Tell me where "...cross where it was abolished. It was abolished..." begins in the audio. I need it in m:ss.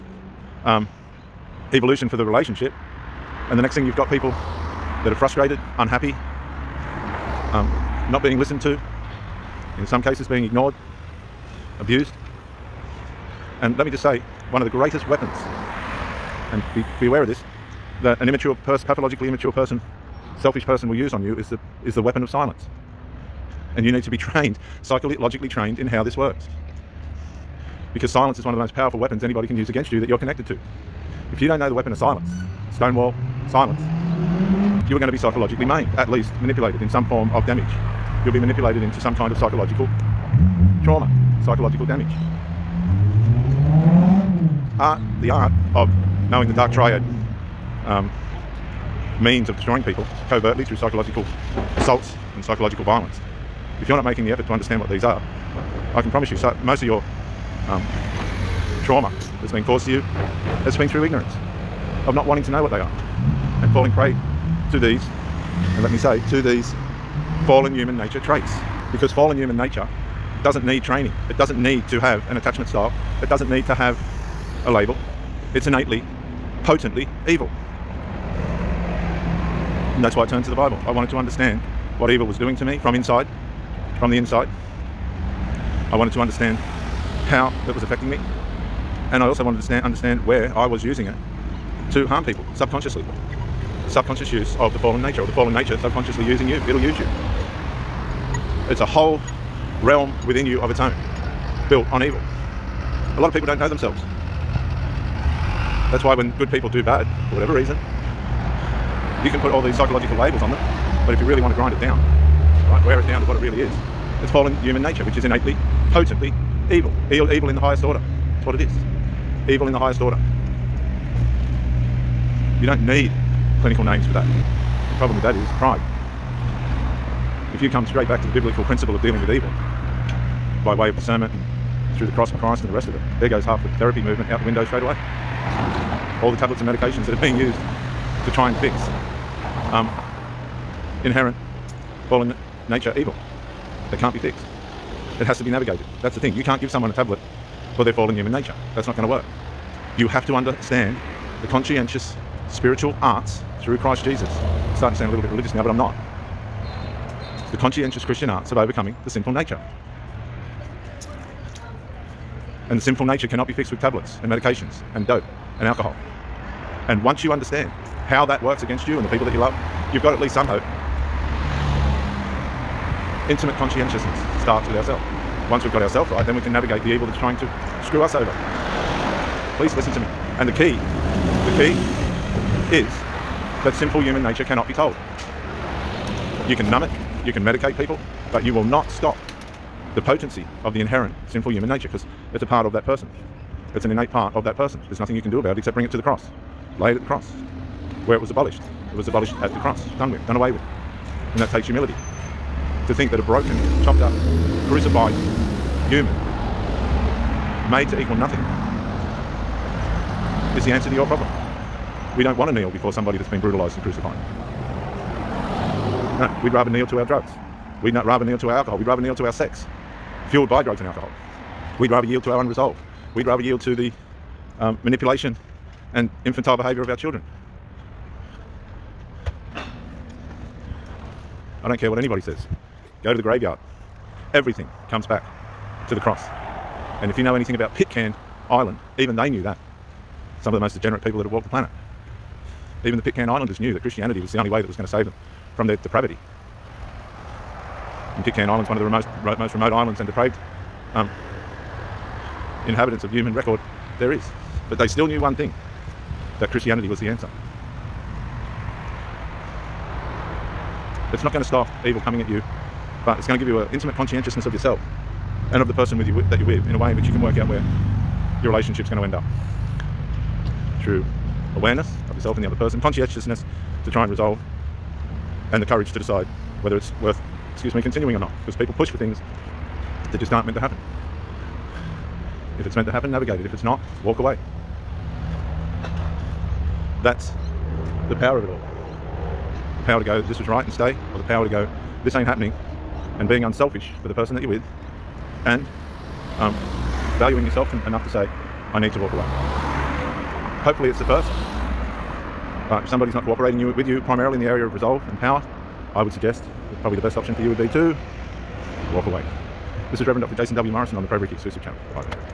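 3:17.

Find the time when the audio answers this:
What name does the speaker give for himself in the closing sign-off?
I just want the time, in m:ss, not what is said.
5:10.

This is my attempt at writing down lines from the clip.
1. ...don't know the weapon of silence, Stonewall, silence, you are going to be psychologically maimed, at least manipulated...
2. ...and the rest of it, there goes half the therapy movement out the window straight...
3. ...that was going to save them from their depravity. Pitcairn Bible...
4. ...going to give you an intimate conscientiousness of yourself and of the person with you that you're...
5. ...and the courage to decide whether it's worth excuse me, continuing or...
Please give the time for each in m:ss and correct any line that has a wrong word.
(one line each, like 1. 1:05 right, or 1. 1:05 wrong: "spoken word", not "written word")
1. 0:31 right
2. 2:12 right
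3. 4:04 wrong: "Islands", not "Bible"
4. 4:23 right
5. 4:35 right.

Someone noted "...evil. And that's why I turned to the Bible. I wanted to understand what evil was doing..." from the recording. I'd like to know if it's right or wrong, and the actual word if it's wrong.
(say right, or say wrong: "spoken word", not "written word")
right.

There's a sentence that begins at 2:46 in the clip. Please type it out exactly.
And once you understand how that works against you and the people that you love, you've got at least some hope.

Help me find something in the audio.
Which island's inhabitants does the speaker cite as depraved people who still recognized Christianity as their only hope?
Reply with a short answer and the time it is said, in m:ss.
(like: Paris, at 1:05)
Pitcairn Island, at 3:57.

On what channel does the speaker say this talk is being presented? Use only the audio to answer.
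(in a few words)
ProBrick Exclusive Channel.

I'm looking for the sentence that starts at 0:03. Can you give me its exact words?
And the next thing you've got people that are frustrated, unhappy, um, not being listened to, in some cases being ignored, abused.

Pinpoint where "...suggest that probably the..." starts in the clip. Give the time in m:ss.
5:06.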